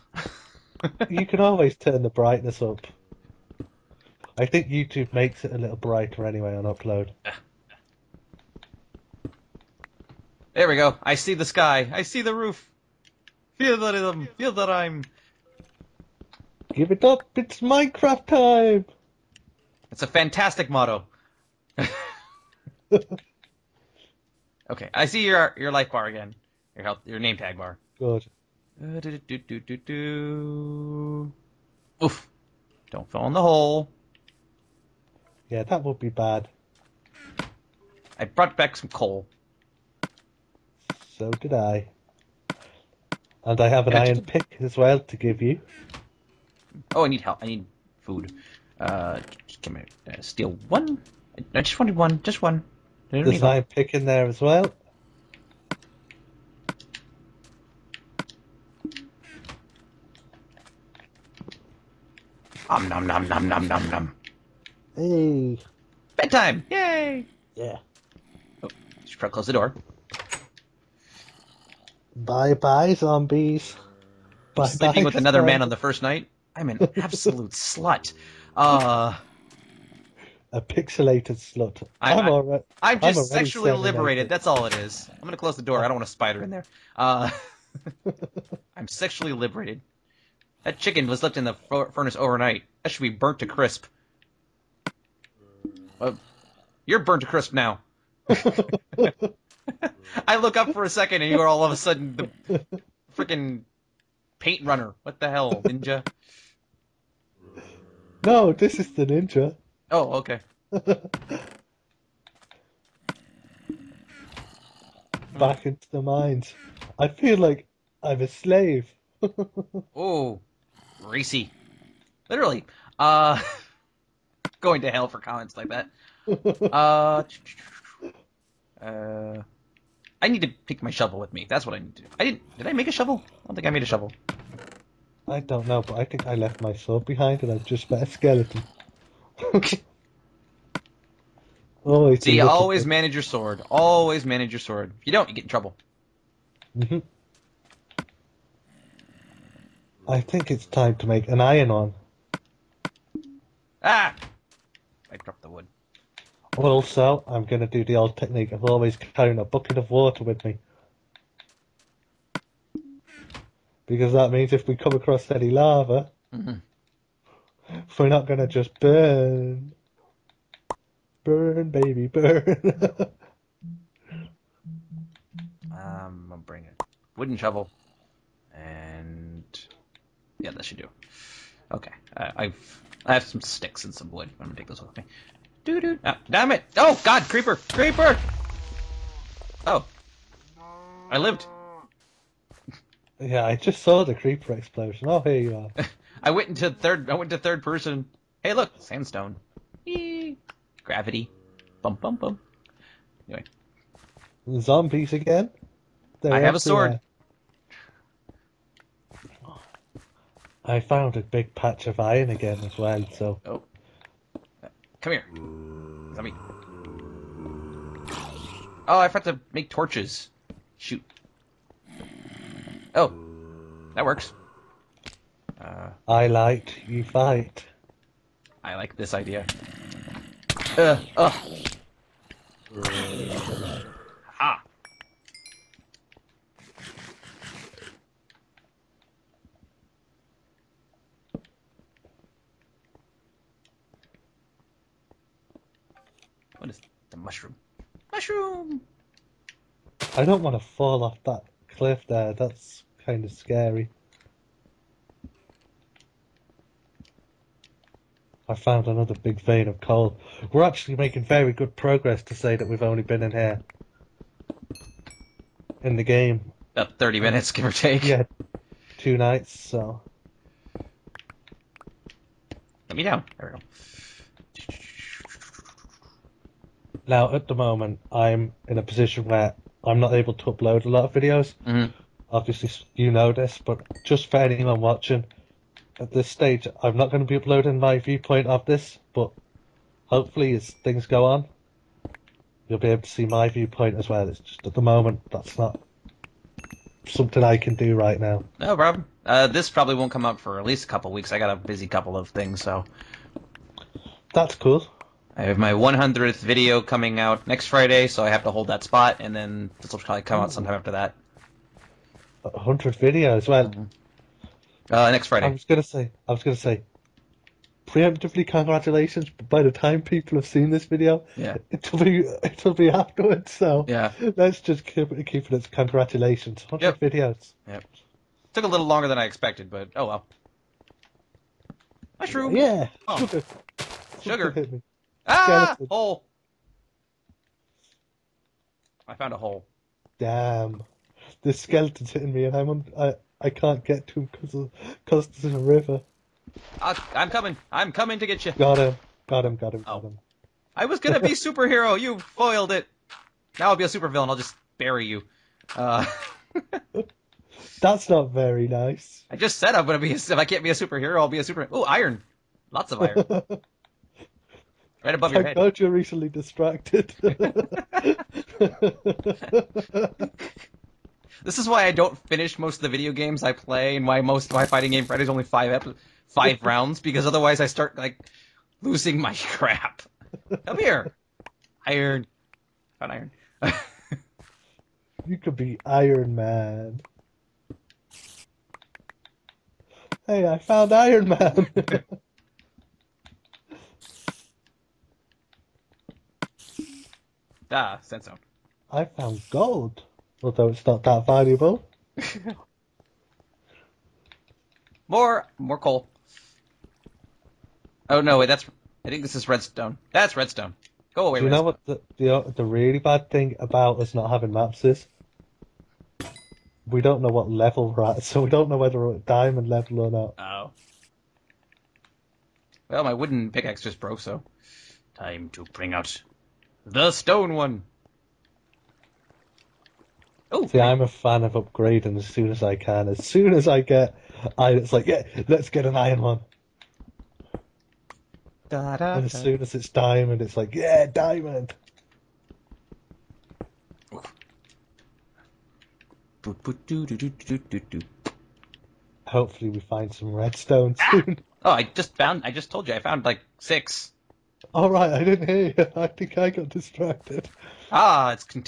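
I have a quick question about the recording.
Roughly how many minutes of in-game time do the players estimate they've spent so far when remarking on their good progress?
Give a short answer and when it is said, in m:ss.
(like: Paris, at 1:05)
30 minutes, at 4:26.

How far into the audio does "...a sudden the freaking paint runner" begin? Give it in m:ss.
1:41.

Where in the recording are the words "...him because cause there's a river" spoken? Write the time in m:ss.
5:44.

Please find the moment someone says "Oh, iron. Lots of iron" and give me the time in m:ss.
6:01.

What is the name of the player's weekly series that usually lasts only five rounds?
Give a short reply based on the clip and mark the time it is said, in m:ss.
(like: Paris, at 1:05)
Fighting Game Friday, at 6:14.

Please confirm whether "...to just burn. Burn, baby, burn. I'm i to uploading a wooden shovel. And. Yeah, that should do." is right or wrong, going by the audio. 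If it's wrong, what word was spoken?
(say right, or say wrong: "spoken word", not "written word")
wrong: "bring", not "uploading".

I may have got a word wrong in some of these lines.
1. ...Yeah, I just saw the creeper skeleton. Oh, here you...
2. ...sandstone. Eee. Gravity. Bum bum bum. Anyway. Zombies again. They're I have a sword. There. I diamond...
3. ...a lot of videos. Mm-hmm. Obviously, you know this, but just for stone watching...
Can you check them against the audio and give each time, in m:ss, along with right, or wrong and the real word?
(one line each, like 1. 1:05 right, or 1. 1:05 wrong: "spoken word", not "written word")
1. 3:13 wrong: "explosion", not "skeleton"
2. 3:18 wrong: "found", not "diamond"
3. 4:40 wrong: "anyone", not "stone".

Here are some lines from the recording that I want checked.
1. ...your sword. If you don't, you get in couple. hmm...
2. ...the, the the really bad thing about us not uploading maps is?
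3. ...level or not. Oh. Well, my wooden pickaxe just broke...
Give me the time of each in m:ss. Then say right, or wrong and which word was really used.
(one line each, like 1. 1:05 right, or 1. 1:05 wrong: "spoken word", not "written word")
1. 2:24 wrong: "trouble", not "couple"
2. 6:51 wrong: "having", not "uploading"
3. 6:59 right.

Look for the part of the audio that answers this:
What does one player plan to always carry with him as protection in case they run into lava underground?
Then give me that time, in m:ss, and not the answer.
2:39.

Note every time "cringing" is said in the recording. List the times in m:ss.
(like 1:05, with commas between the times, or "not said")
not said.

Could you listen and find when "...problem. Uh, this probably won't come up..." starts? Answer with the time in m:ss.
4:58.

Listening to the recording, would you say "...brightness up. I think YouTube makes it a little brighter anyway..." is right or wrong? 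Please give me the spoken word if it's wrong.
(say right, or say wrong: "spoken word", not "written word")
right.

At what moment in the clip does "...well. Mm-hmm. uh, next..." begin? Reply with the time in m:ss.
5:13.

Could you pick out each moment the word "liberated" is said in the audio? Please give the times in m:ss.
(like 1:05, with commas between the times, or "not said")
1:23, 1:29.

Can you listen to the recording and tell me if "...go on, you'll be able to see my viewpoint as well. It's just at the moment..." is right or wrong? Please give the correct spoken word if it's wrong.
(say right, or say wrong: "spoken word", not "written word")
right.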